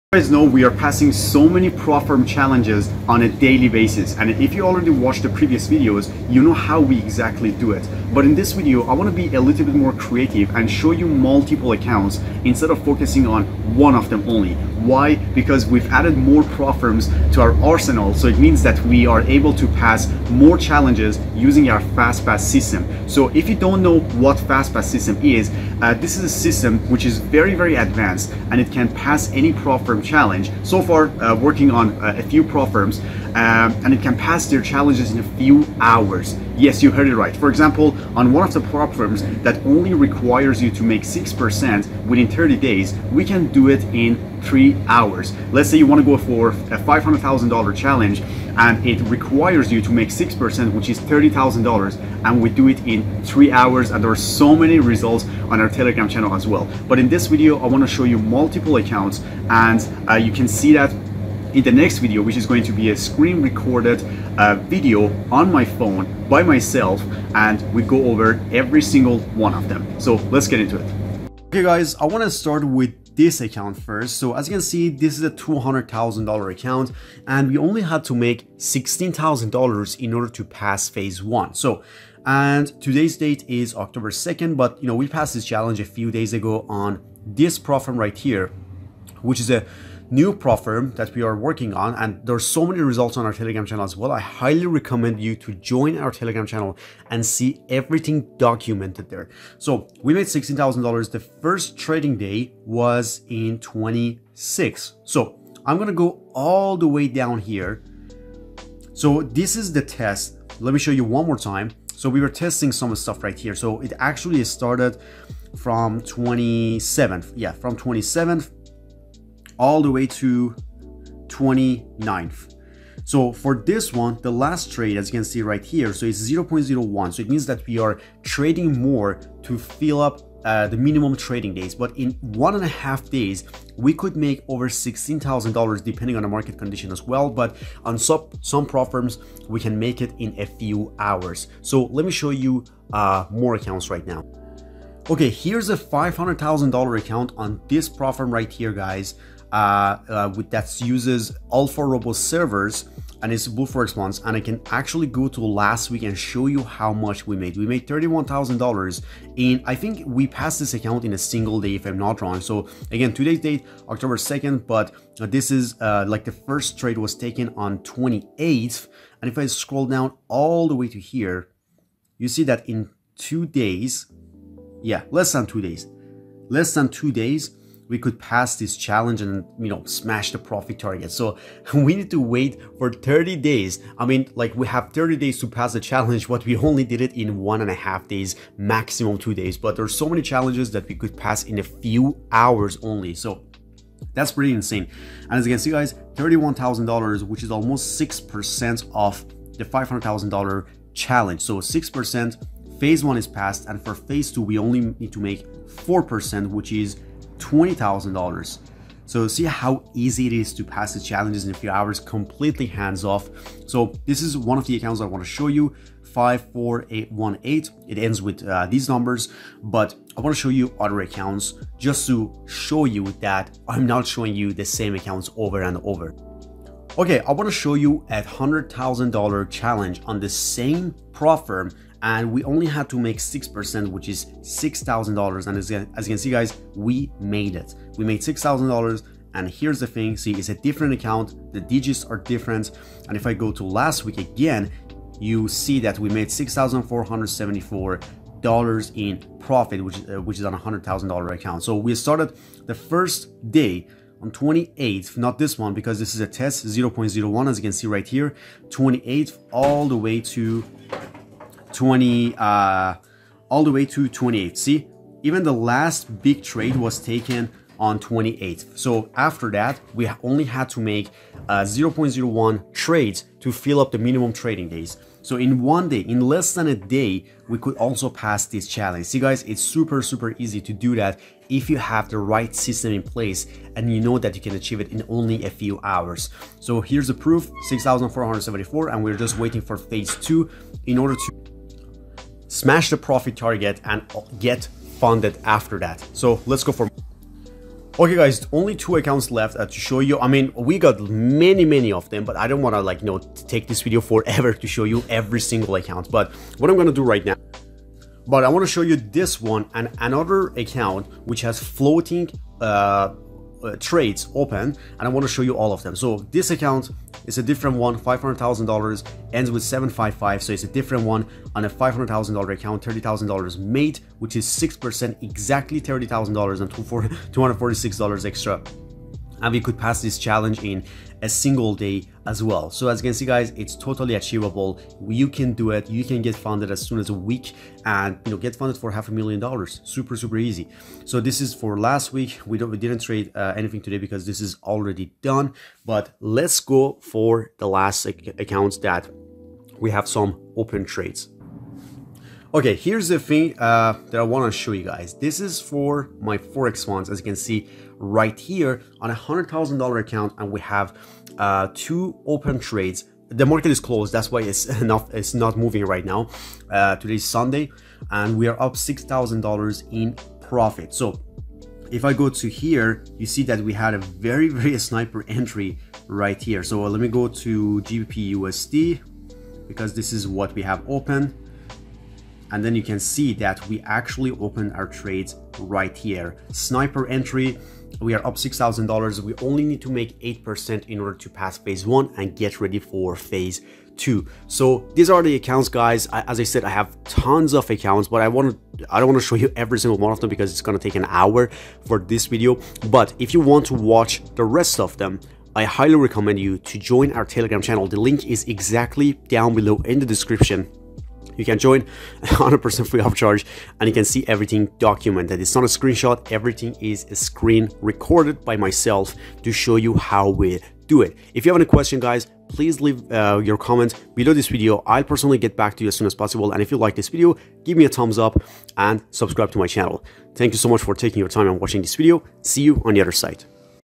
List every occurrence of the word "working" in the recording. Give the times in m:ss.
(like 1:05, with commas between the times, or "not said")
0:31, 1:31.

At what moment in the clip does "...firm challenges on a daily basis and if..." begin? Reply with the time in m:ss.
0:02.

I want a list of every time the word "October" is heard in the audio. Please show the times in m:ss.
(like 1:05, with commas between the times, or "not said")
1:23, 2:43.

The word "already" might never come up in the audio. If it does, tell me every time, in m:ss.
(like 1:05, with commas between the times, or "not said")
0:04, 5:44.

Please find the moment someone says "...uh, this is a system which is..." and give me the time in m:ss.
0:25.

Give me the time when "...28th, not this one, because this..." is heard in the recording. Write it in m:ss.
4:14.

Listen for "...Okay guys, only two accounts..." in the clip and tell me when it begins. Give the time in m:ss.
4:57.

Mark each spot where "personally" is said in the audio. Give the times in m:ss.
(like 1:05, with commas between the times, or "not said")
7:05.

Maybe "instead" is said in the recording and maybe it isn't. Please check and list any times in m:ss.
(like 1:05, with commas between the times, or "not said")
0:12.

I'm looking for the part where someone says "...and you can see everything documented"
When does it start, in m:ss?
6:53.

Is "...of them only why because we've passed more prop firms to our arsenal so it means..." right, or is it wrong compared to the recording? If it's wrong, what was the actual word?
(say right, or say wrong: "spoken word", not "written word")
wrong: "added", not "passed".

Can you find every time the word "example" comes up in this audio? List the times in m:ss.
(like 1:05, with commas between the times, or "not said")
0:37.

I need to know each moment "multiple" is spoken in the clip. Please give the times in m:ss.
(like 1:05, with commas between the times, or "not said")
0:11, 0:58.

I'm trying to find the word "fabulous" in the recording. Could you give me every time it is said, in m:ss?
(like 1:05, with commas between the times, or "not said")
not said.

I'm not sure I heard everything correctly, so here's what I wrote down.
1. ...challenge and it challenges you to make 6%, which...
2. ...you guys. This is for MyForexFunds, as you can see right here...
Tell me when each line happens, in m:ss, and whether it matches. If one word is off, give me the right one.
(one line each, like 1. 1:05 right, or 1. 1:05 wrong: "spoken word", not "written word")
1. 0:47 wrong: "requires", not "challenges"
2. 5:54 right.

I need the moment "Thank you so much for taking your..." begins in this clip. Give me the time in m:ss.
7:10.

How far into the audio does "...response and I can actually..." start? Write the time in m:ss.
2:33.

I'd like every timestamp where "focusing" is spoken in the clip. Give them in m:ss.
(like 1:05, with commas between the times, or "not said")
0:12.